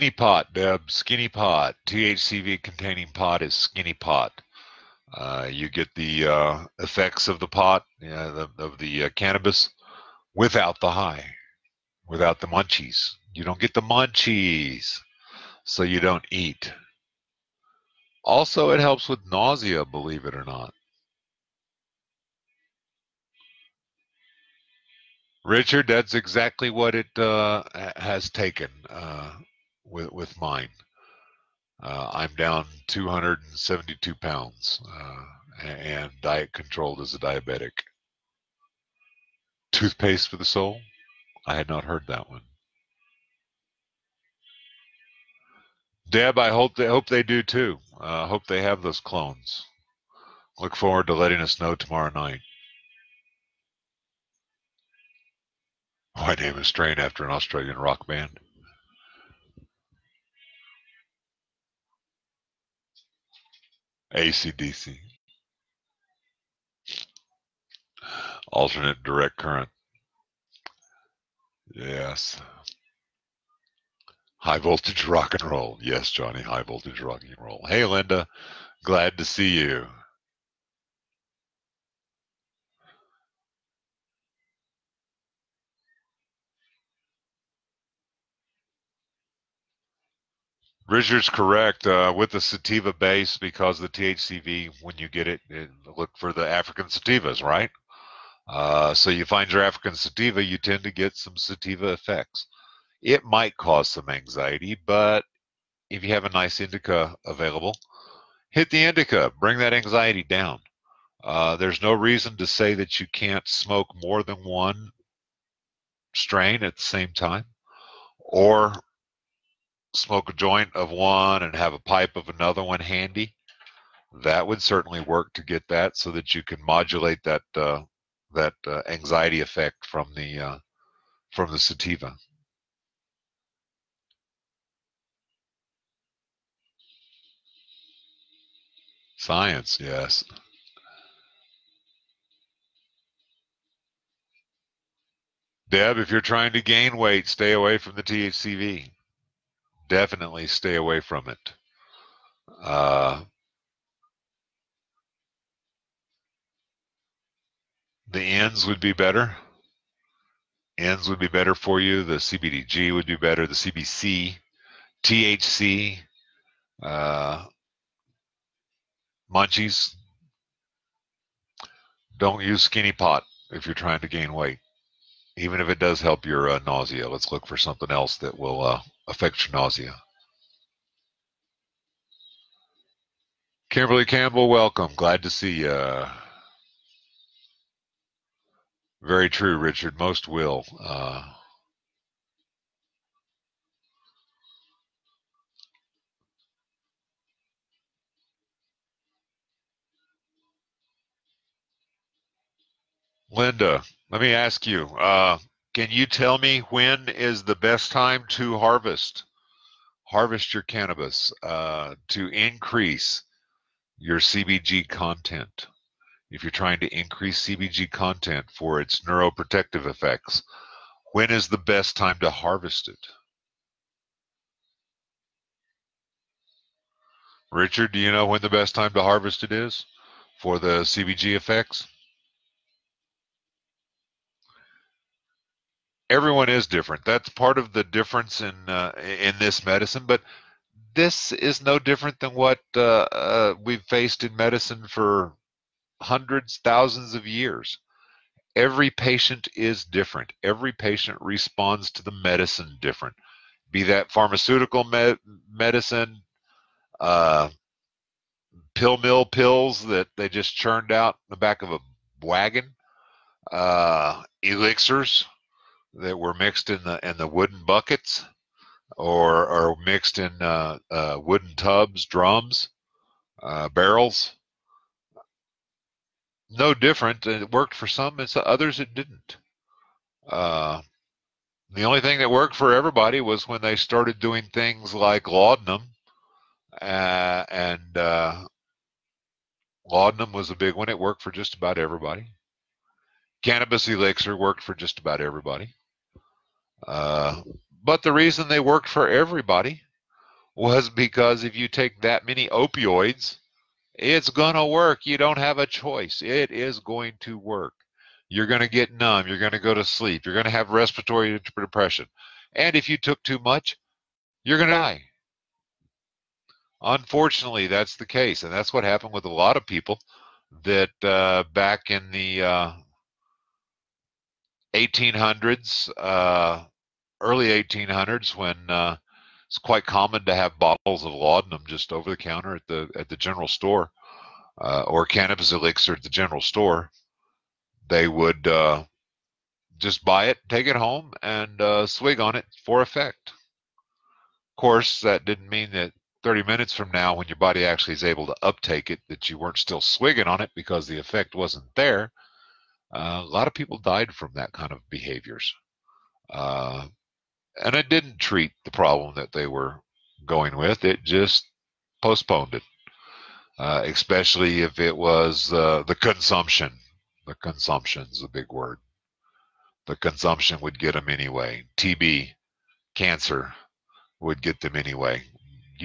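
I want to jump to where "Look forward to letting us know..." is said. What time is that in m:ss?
0:50.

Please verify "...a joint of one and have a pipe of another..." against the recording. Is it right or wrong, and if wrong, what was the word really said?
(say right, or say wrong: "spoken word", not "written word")
right.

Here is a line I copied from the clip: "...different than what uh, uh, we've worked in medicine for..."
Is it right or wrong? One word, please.
wrong.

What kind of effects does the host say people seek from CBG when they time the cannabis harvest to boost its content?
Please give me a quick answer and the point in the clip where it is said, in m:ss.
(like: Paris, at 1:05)
Neuroprotective, at 3:39.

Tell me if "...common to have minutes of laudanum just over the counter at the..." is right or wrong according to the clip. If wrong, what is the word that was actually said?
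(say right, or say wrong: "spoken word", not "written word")
wrong: "bottles", not "minutes".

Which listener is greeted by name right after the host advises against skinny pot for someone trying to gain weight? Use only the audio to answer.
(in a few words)
Kimberly Campbell.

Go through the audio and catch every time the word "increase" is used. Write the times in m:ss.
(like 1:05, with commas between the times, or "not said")
3:32, 3:36.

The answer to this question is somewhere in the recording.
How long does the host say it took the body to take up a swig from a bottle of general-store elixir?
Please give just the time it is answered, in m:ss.
5:46.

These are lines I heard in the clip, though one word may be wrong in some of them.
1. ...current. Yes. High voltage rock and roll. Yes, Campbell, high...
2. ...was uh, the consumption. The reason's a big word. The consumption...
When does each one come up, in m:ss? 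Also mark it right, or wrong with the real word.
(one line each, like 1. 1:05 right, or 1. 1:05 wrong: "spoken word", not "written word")
1. 1:09 wrong: "Johnny", not "Campbell"
2. 6:04 wrong: "consumption", not "reason".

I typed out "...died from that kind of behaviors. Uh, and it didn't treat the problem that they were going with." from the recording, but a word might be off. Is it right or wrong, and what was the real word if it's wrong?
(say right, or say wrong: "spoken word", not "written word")
right.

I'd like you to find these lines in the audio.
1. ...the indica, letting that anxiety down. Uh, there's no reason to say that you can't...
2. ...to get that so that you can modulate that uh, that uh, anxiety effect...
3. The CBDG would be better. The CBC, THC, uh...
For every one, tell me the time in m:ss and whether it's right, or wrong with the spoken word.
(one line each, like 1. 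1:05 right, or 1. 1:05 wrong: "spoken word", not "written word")
1. 1:48 wrong: "bring", not "letting"
2. 2:05 right
3. 2:42 right.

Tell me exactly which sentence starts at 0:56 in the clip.
My name is Strain after an Australian rock band?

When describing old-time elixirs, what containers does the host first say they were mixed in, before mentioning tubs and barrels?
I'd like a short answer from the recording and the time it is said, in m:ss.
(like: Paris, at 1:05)
Wooden buckets, at 4:27.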